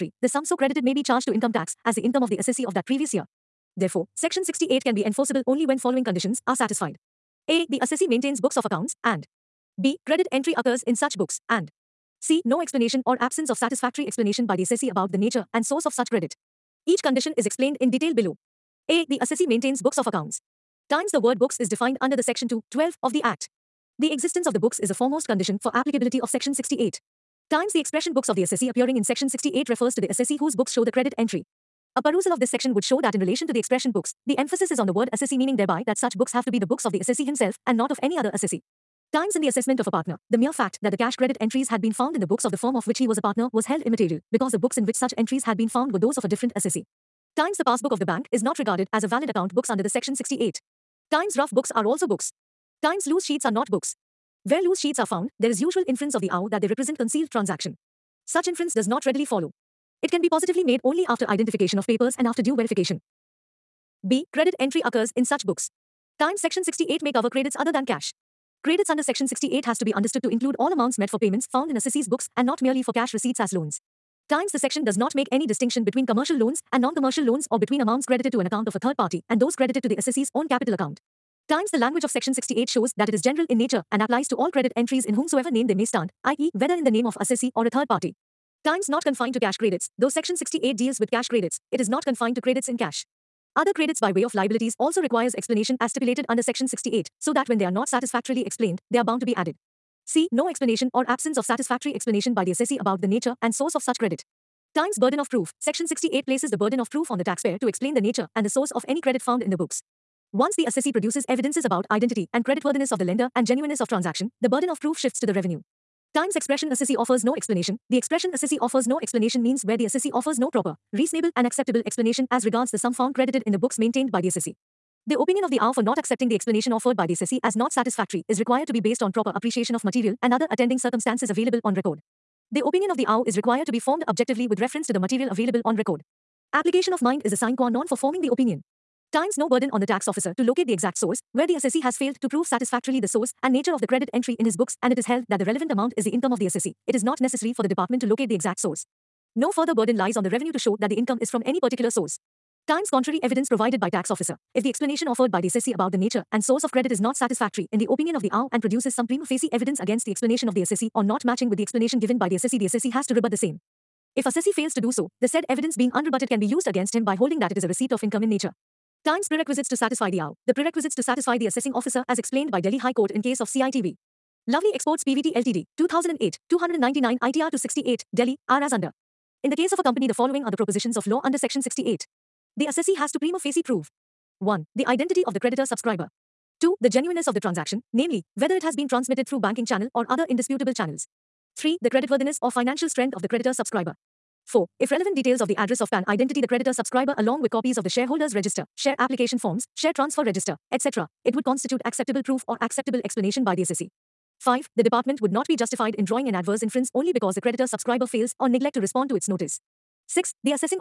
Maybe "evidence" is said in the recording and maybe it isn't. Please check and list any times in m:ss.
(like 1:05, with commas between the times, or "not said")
1:51, 2:33, 2:39, 2:45.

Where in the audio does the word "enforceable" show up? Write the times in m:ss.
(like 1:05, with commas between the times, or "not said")
0:05.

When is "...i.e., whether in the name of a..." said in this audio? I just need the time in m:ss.
1:26.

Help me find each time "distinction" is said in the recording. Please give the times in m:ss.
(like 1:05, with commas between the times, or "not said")
1:15.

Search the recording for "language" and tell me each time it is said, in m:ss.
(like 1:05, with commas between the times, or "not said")
1:21.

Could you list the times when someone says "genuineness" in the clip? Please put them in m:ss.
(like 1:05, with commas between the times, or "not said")
1:53, 3:06.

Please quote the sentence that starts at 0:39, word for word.
Times in the assessment of a partner.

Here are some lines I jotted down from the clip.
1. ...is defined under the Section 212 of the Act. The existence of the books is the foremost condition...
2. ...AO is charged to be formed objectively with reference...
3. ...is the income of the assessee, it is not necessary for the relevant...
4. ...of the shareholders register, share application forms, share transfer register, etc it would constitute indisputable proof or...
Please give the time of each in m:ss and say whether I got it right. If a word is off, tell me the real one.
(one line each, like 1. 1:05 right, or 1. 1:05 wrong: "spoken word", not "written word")
1. 0:21 right
2. 2:13 wrong: "required", not "charged"
3. 2:25 wrong: "department", not "relevant"
4. 3:17 wrong: "acceptable", not "indisputable".